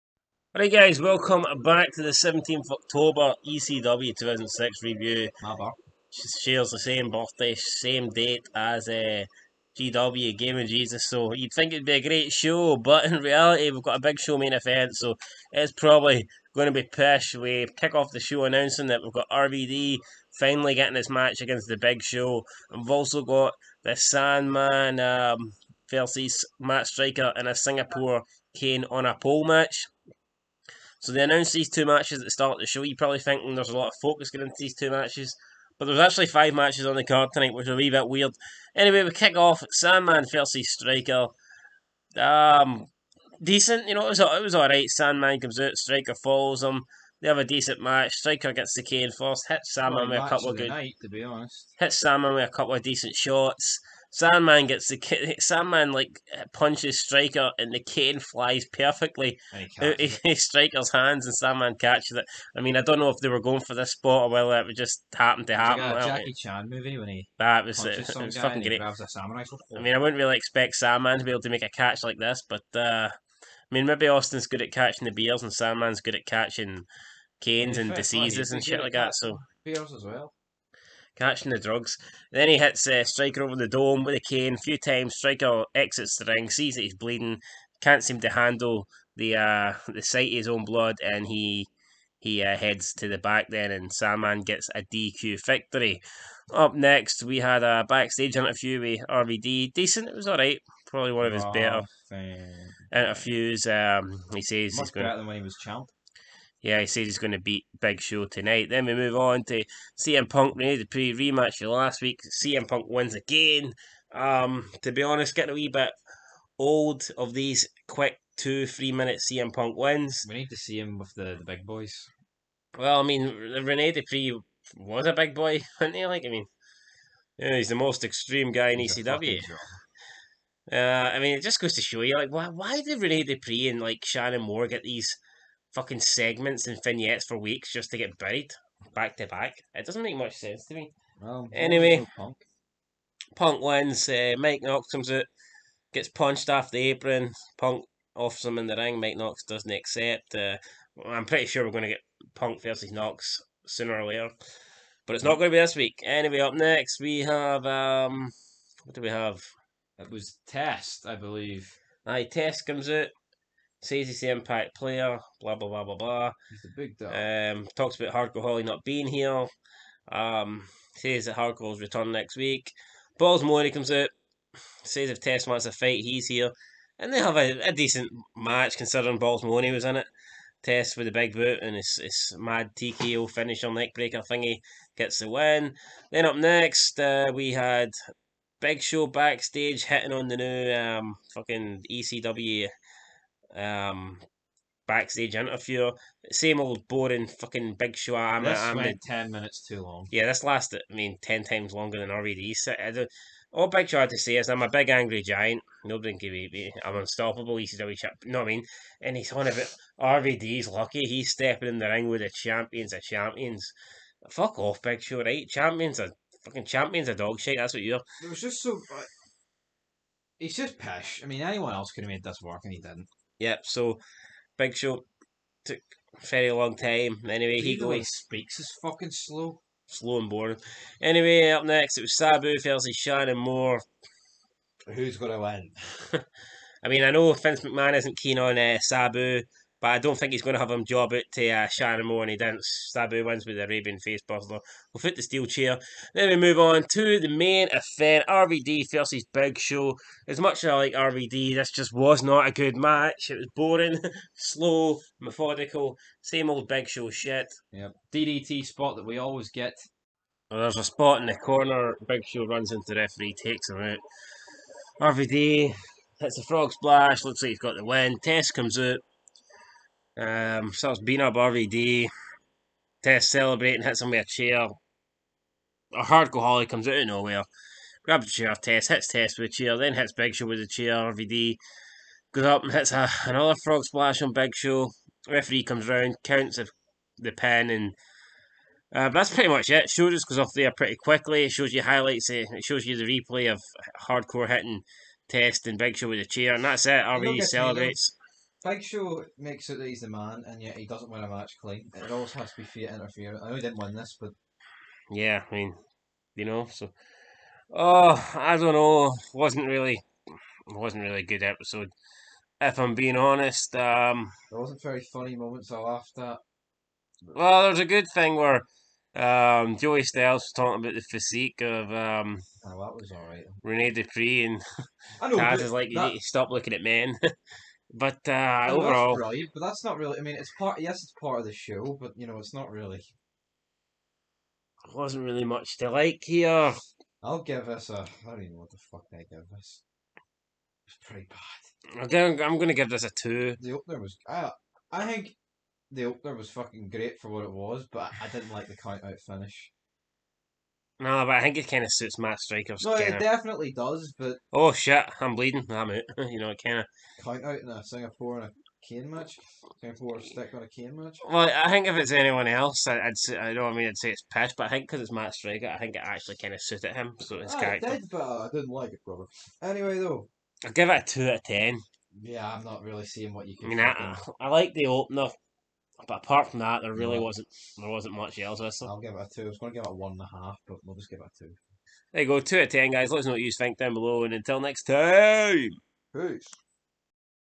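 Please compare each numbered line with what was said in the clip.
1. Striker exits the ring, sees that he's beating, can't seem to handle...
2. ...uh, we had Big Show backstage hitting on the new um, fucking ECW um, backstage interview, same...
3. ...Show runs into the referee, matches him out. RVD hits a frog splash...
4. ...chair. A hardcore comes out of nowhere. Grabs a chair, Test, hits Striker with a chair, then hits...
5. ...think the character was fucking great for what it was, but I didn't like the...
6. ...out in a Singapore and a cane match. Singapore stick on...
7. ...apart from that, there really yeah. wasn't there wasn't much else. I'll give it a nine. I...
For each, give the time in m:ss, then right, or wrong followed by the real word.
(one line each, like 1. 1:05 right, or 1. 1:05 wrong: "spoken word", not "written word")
1. 1:25 wrong: "bleeding", not "beating"
2. 3:06 right
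3. 4:22 wrong: "takes", not "matches"
4. 4:34 wrong: "Test", not "Striker"
5. 5:45 wrong: "opener", not "character"
6. 5:57 right
7. 6:16 wrong: "two", not "nine".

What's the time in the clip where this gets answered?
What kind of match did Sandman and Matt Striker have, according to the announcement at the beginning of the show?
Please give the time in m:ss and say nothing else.
0:27.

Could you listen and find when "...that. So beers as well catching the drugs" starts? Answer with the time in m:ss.
1:18.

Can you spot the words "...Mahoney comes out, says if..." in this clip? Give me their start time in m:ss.
2:53.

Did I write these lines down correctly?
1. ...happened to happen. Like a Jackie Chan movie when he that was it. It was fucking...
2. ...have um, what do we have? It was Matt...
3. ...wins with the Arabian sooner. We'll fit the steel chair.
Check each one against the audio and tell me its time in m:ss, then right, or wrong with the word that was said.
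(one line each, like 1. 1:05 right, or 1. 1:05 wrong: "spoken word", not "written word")
1. 1:05 right
2. 2:37 wrong: "Test", not "Matt"
3. 4:03 wrong: "facebuster", not "sooner".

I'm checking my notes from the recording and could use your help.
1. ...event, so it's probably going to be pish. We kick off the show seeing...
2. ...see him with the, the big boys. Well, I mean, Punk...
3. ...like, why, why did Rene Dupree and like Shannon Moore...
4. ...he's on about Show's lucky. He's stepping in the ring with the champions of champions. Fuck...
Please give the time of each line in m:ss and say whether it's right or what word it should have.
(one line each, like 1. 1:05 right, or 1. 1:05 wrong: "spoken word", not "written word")
1. 0:14 wrong: "announcing", not "seeing"
2. 2:00 wrong: "Rene", not "Punk"
3. 2:12 right
4. 3:29 wrong: "RVD", not "Show".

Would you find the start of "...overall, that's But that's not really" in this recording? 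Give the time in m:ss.
5:28.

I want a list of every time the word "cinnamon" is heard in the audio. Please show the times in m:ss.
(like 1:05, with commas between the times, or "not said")
not said.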